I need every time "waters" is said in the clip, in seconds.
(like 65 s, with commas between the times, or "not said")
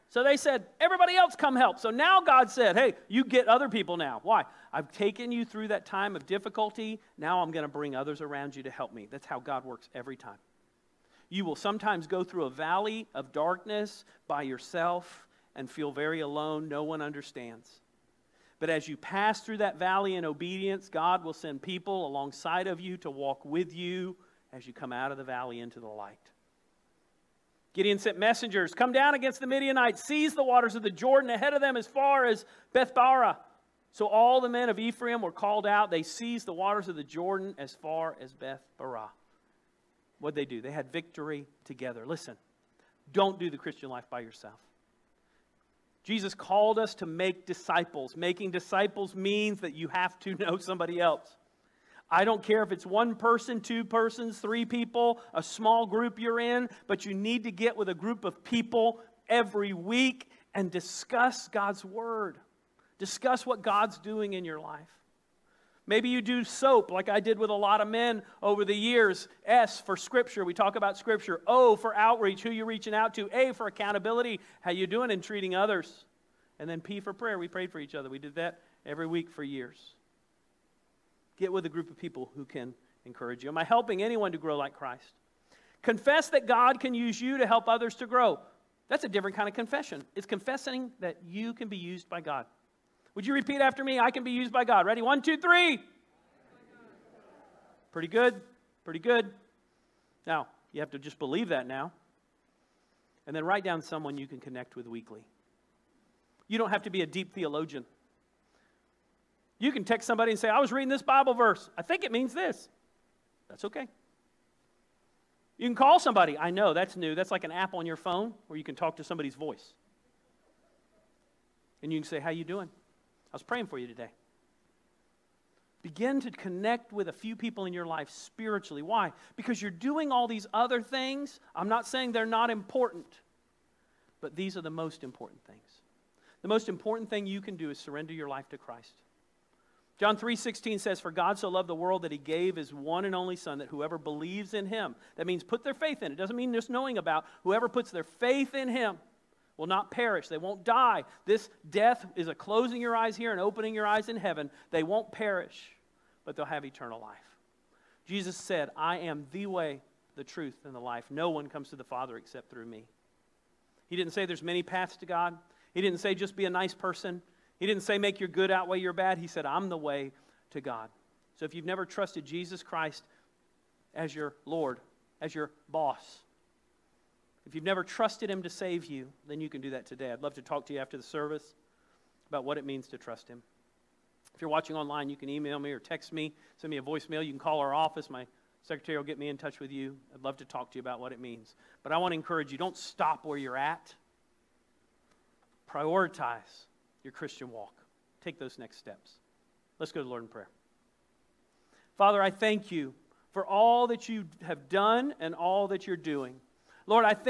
30 s, 36 s.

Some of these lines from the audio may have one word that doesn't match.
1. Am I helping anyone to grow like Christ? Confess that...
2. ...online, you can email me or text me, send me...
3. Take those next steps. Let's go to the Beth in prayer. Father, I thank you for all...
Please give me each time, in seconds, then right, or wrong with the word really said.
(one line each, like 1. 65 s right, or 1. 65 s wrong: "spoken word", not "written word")
1. 83 s right
2. 184 s right
3. 198 s wrong: "Lord", not "Beth".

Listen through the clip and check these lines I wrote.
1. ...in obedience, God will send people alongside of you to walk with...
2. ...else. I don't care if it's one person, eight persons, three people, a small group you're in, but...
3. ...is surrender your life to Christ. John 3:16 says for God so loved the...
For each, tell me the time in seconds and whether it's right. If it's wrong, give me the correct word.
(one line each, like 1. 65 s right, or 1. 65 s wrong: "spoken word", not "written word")
1. 20 s right
2. 50 s wrong: "two", not "eight"
3. 137 s right.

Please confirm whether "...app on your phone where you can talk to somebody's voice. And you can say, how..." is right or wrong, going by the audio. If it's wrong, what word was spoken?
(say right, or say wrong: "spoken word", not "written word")
right.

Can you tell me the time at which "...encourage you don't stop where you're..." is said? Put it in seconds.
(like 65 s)
192 s.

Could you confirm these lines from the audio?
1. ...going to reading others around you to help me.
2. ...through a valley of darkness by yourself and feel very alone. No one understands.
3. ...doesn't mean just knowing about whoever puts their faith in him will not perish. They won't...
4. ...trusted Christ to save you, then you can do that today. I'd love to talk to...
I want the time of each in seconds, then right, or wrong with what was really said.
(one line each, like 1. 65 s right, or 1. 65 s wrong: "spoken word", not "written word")
1. 7 s wrong: "bring", not "reading"
2. 12 s right
3. 146 s right
4. 177 s wrong: "Him", not "Christ".